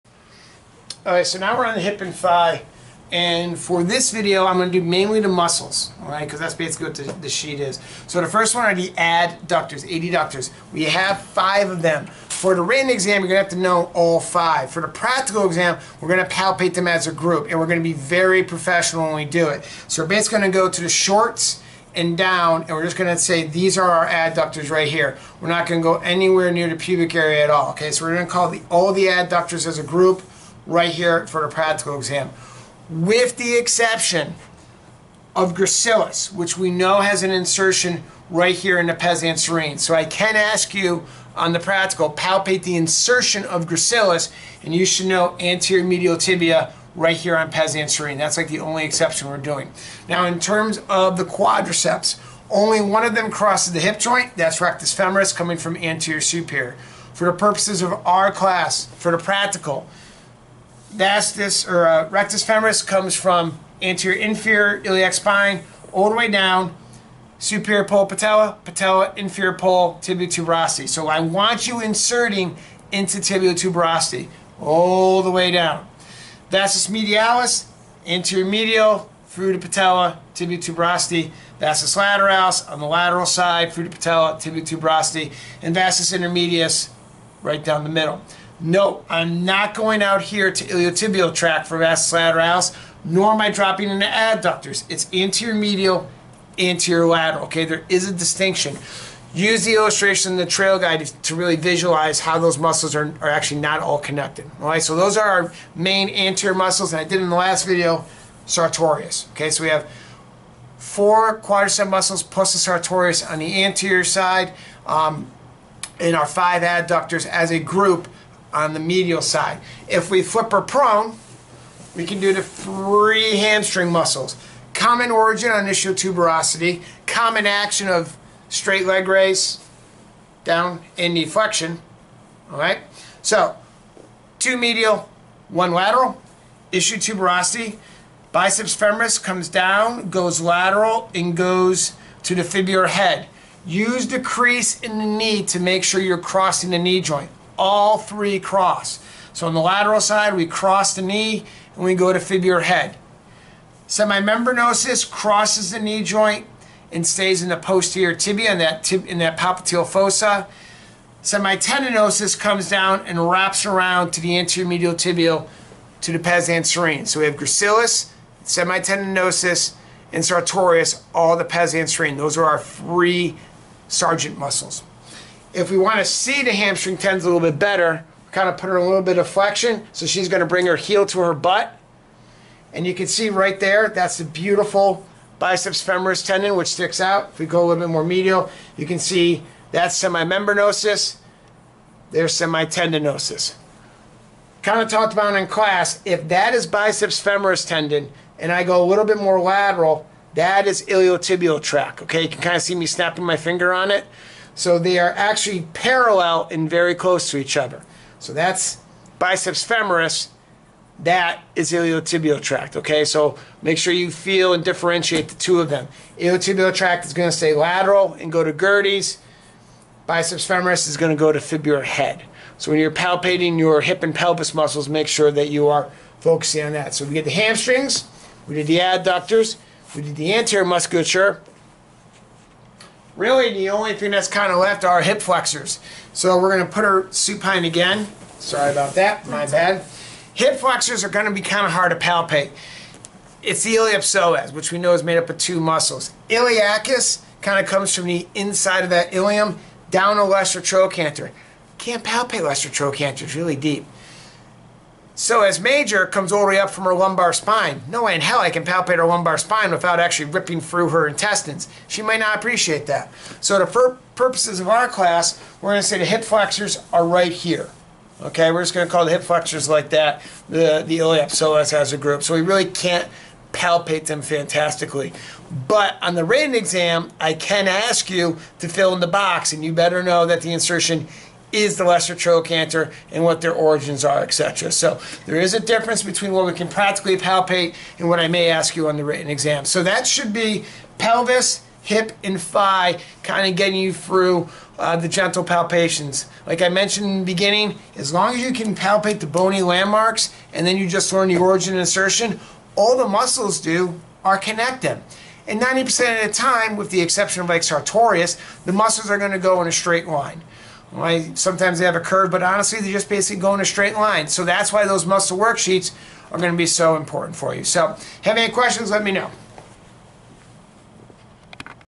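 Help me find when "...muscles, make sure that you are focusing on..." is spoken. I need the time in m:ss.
3:44.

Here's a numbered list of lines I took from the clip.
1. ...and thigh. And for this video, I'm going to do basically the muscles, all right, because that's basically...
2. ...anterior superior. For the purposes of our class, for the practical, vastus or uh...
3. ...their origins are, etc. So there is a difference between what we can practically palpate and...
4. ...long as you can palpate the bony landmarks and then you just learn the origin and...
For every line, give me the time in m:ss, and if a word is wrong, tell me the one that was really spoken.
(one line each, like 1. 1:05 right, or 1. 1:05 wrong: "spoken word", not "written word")
1. 0:02 wrong: "mainly", not "basically"
2. 0:55 right
3. 4:43 right
4. 4:58 right.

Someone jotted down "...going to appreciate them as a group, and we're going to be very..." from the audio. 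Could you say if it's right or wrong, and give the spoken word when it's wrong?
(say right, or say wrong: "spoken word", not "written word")
wrong: "palpate", not "appreciate".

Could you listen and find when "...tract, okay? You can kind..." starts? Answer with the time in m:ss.
3:21.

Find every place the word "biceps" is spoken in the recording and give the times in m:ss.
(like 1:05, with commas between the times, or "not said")
2:18, 3:05, 3:16, 3:29, 3:40.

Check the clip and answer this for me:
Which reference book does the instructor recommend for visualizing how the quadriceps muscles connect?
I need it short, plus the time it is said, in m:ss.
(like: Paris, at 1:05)
Trail Guide, at 1:40.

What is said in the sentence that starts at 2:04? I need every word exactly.
Common origin on ischial tuberosity, common action of straight leg raise, down, and knee flexion.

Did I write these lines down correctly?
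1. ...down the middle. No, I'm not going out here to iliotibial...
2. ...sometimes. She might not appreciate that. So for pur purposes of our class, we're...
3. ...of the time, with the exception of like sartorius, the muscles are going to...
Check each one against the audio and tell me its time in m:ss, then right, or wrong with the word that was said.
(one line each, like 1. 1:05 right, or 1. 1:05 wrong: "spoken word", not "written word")
1. 1:27 right
2. 4:21 wrong: "intestines", not "sometimes"
3. 5:06 right.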